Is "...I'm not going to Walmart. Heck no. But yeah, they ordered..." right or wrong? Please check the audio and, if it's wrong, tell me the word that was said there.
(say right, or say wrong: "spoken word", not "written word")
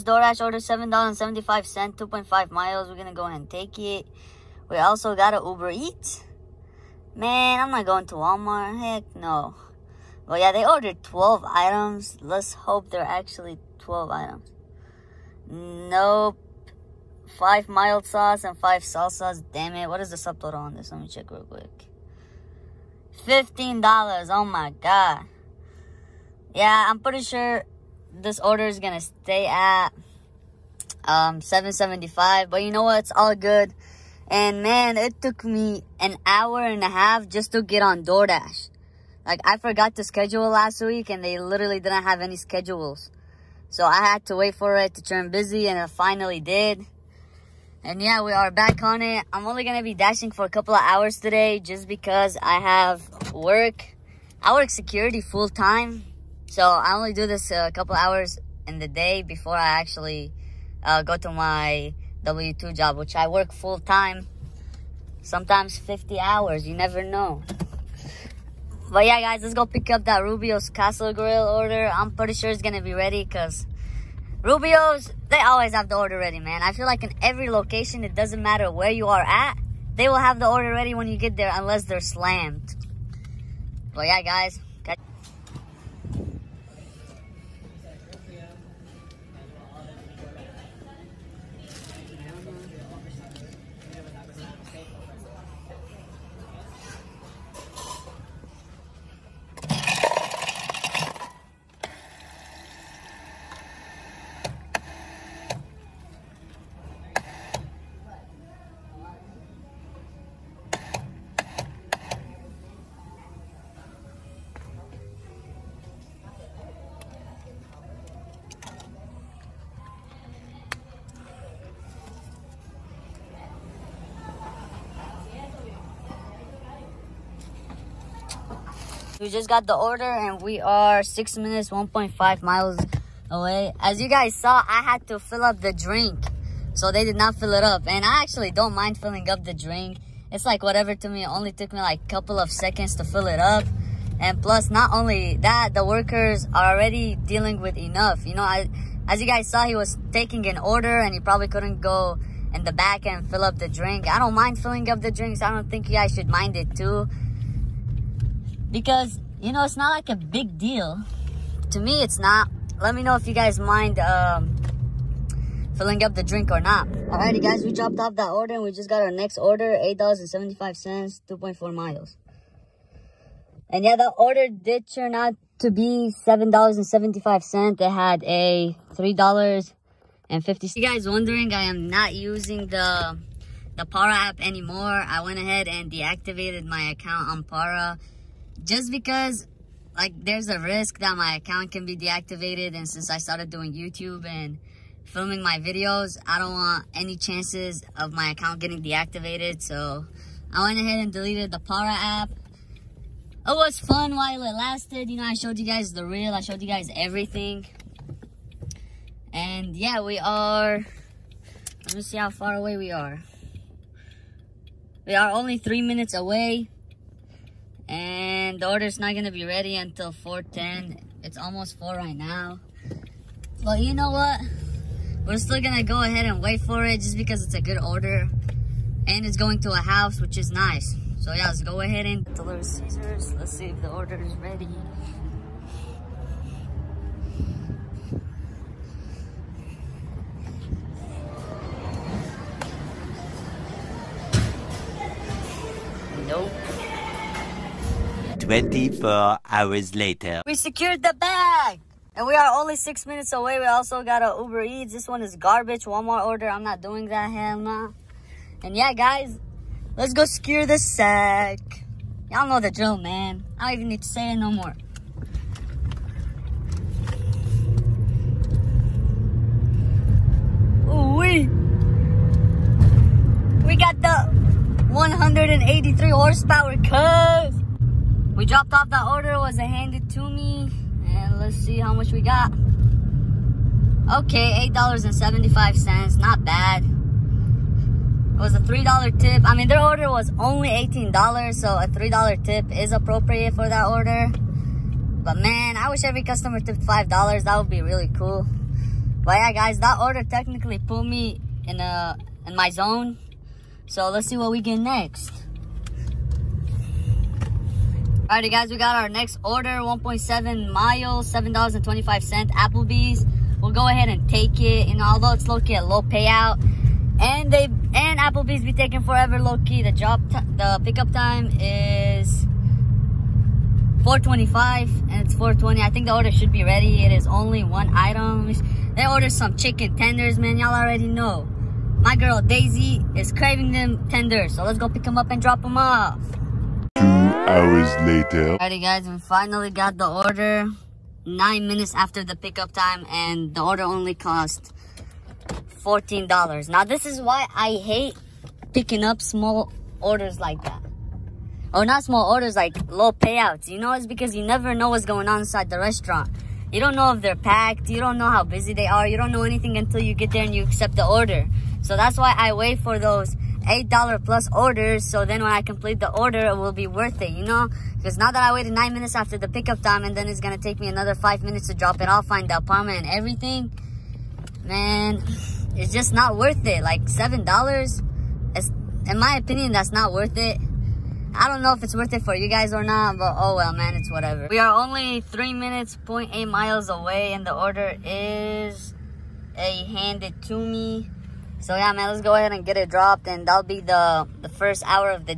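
right.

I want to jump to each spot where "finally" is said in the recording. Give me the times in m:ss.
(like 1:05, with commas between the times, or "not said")
0:45, 5:39.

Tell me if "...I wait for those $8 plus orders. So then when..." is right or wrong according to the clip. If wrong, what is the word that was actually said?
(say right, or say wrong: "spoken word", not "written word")
right.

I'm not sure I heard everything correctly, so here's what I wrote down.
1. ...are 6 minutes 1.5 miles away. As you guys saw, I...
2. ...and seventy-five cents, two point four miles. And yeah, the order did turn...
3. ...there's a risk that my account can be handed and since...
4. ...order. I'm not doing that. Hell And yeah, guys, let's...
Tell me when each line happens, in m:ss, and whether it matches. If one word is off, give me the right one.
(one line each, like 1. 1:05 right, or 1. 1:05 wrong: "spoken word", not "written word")
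1. 2:10 right
2. 2:50 right
3. 3:10 wrong: "deactivated", not "handed"
4. 4:16 right.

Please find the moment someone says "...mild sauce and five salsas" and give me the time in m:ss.
0:17.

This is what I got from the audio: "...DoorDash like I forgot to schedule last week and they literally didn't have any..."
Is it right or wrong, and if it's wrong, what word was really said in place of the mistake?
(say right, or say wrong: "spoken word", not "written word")
right.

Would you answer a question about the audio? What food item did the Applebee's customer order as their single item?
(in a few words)
Chicken tenders.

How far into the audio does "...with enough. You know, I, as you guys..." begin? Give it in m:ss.
2:27.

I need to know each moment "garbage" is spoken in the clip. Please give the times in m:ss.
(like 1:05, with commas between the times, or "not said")
4:15.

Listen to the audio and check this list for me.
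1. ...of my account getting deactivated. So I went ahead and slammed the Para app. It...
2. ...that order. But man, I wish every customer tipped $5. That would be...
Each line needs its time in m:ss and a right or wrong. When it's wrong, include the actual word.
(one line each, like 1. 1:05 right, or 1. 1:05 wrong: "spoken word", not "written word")
1. 3:17 wrong: "deleted", not "slammed"
2. 4:53 right.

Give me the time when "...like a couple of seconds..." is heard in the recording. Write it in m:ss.
2:21.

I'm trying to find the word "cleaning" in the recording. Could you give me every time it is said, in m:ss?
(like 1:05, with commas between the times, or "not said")
not said.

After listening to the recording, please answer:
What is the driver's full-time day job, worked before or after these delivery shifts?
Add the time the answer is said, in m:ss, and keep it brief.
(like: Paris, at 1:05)
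Security, at 0:54.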